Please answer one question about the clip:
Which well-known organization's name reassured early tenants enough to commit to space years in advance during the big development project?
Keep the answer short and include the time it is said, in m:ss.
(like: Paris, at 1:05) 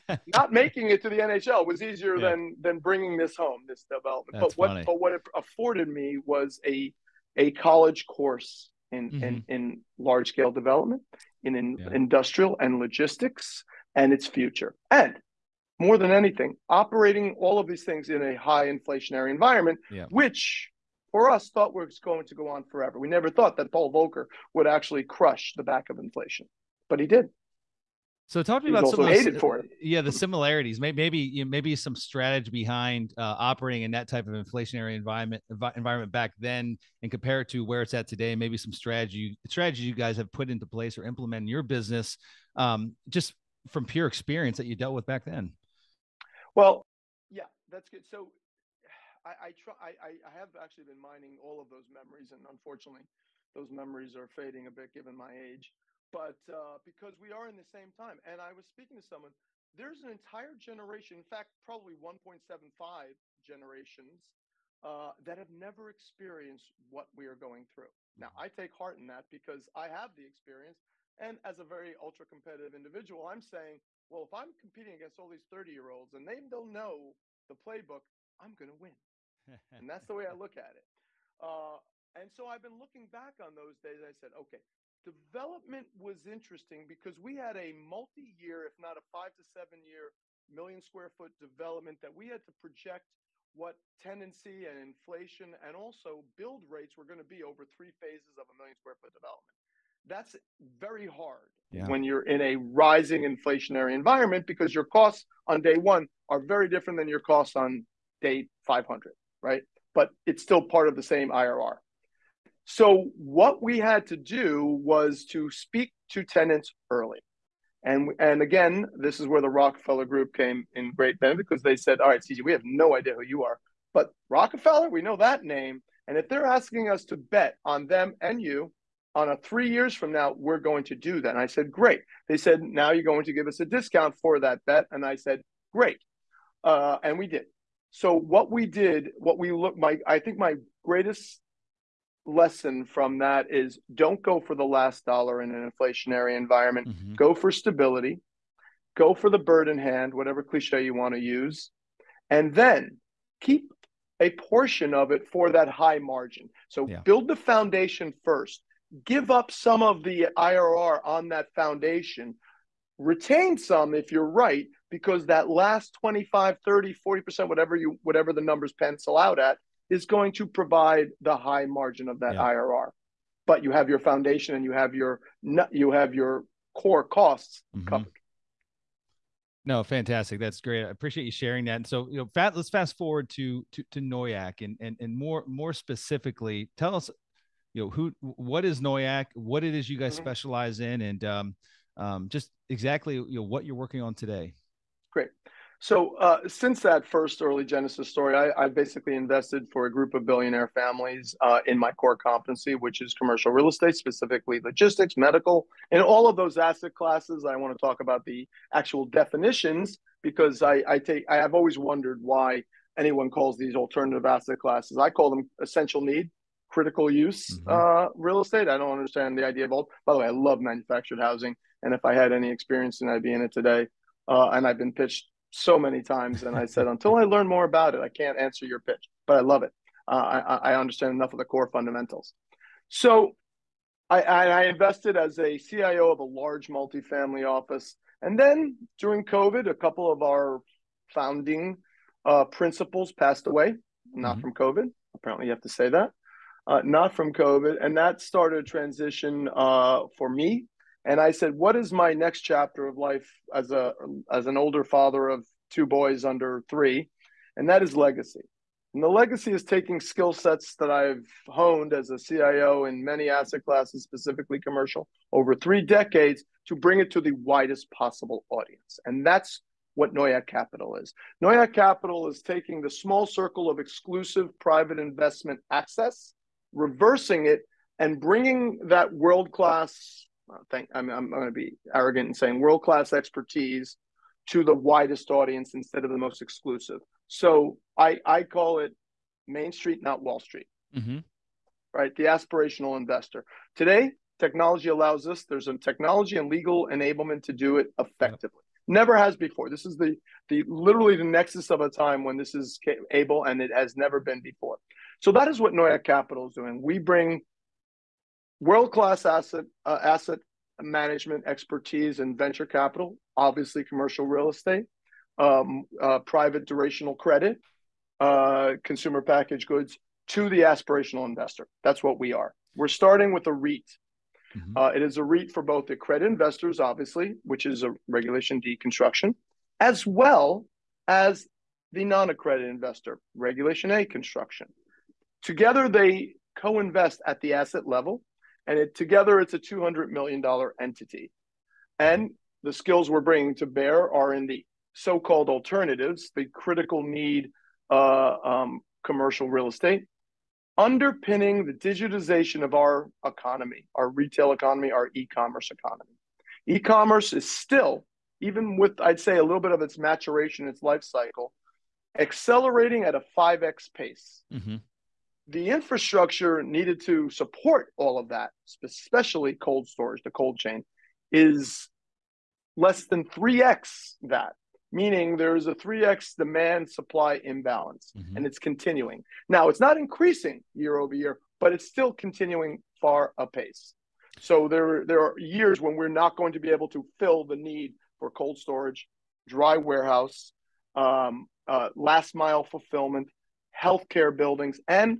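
Rockefeller Group, at 1:59.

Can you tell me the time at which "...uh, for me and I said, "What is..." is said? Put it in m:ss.
4:09.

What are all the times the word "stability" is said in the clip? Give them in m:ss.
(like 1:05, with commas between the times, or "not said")
2:27.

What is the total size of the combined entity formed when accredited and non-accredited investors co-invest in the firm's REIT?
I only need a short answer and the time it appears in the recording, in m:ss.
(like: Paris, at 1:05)
$200 million, at 5:39.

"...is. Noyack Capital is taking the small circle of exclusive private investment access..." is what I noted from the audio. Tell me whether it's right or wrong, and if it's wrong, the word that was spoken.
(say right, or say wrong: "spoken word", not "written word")
right.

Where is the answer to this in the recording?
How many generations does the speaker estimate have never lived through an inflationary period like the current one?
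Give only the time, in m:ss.
1:01.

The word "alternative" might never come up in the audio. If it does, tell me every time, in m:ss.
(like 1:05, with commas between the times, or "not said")
3:33, 5:45.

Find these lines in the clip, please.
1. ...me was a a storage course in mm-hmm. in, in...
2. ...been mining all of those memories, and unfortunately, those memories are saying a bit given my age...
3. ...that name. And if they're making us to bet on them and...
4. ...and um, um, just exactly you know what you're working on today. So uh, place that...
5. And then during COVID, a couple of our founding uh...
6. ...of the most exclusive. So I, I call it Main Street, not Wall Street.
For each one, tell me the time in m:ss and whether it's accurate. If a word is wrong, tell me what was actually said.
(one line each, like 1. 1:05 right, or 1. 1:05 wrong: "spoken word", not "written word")
1. 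0:05 wrong: "college", not "storage"
2. 0:50 wrong: "fading", not "saying"
3. 2:05 wrong: "asking", not "making"
4. 3:11 wrong: "since", not "place"
5. 3:58 right
6. 4:46 right.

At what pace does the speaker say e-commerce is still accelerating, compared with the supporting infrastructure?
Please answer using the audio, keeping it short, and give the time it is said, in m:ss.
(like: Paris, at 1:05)
5x, at 6:03.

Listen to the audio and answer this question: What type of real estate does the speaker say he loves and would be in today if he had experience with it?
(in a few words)
Manufactured housing.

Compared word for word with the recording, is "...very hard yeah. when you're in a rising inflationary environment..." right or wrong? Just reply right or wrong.
right.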